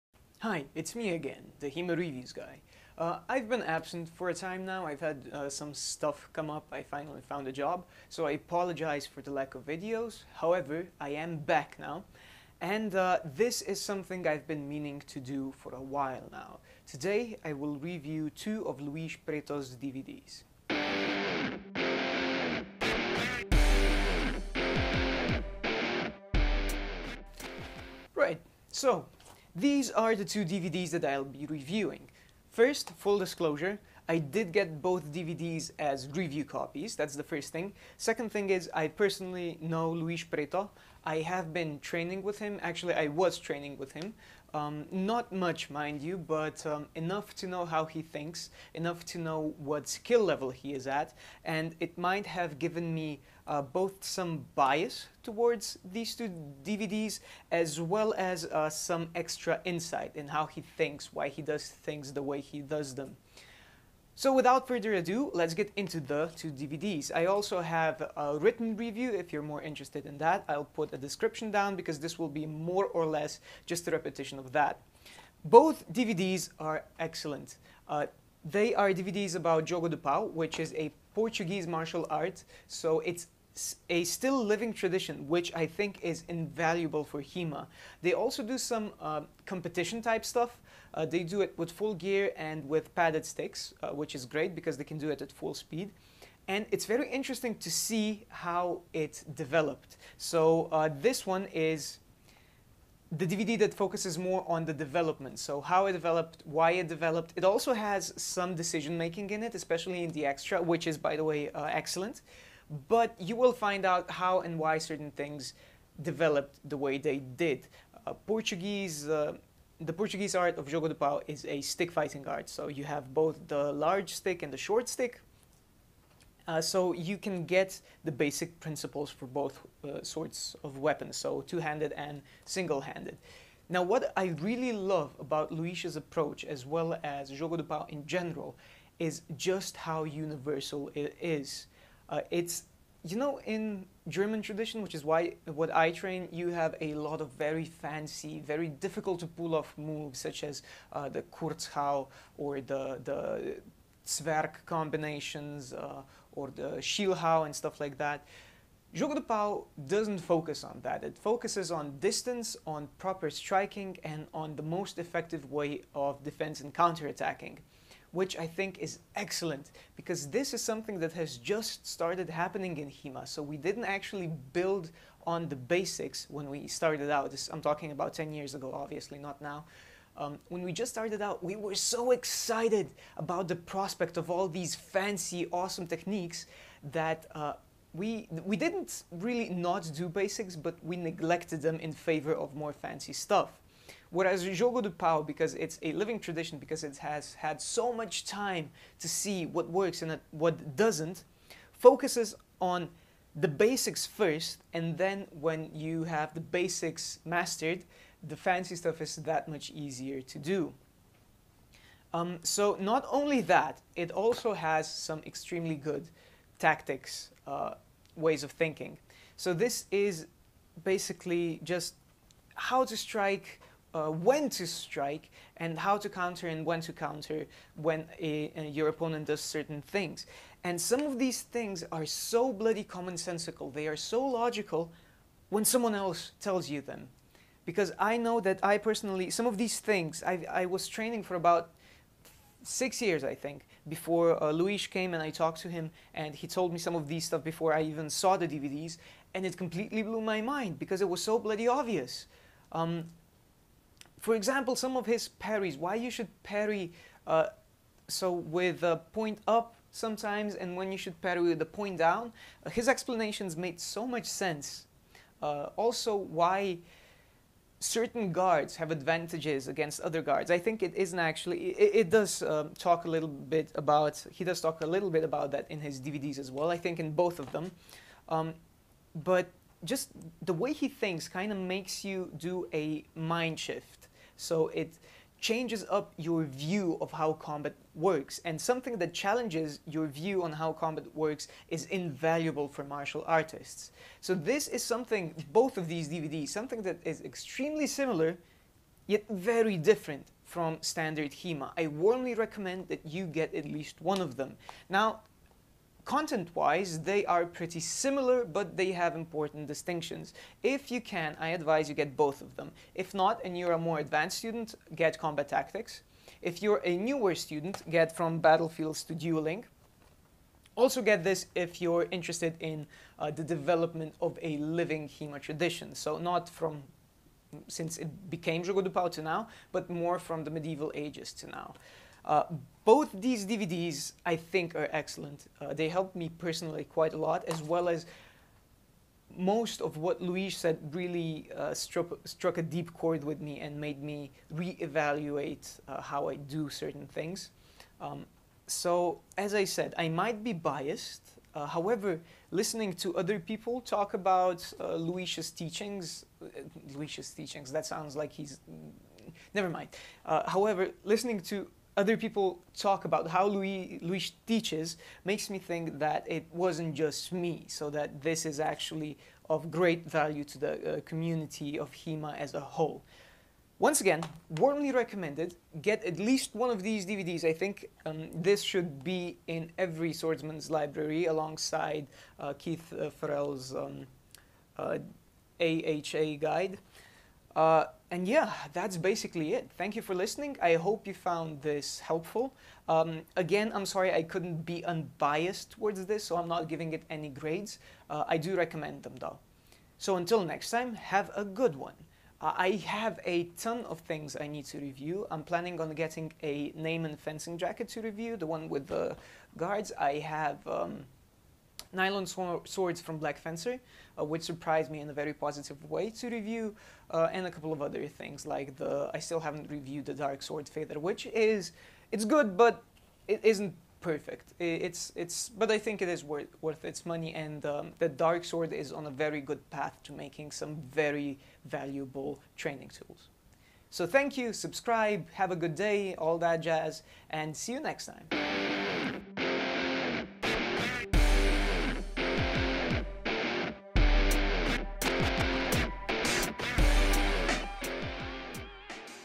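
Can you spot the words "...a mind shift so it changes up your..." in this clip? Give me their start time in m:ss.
4:42.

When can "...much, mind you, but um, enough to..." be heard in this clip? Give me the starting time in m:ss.
0:45.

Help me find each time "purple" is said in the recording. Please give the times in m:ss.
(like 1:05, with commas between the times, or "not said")
not said.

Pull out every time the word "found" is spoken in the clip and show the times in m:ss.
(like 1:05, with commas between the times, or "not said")
0:07, 6:31.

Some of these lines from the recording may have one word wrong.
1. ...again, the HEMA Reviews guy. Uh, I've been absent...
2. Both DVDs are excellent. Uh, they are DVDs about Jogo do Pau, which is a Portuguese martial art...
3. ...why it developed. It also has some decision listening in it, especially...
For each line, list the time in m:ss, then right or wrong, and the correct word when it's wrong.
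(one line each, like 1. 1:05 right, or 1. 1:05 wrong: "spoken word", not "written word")
1. 0:01 right
2. 1:15 right
3. 1:46 wrong: "making", not "listening".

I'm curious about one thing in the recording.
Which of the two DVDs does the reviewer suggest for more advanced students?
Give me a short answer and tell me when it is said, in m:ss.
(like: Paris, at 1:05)
Combat Tactics, at 5:15.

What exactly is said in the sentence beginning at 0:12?
And uh, this is something I've been meaning to do for a while now.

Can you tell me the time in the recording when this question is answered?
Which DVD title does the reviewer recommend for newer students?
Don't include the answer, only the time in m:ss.
5:18.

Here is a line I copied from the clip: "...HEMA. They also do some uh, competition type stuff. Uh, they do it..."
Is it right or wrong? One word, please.
right.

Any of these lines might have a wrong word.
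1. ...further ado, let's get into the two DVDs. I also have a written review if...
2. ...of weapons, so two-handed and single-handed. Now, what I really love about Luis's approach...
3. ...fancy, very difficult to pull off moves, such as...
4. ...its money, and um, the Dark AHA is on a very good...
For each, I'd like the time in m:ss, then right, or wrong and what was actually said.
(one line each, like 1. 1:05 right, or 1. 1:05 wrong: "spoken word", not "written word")
1. 1:04 right
2. 2:10 right
3. 2:27 right
4. 7:06 wrong: "Sword", not "AHA".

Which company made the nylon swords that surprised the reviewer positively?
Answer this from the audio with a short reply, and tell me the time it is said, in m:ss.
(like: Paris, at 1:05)
Black Fencer, at 6:53.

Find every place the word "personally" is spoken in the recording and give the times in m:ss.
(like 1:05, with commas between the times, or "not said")
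0:38, 3:58, 5:36.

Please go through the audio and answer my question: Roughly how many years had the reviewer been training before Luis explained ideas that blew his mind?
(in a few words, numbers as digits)
6.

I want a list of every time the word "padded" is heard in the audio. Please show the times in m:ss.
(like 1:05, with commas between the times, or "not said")
1:32.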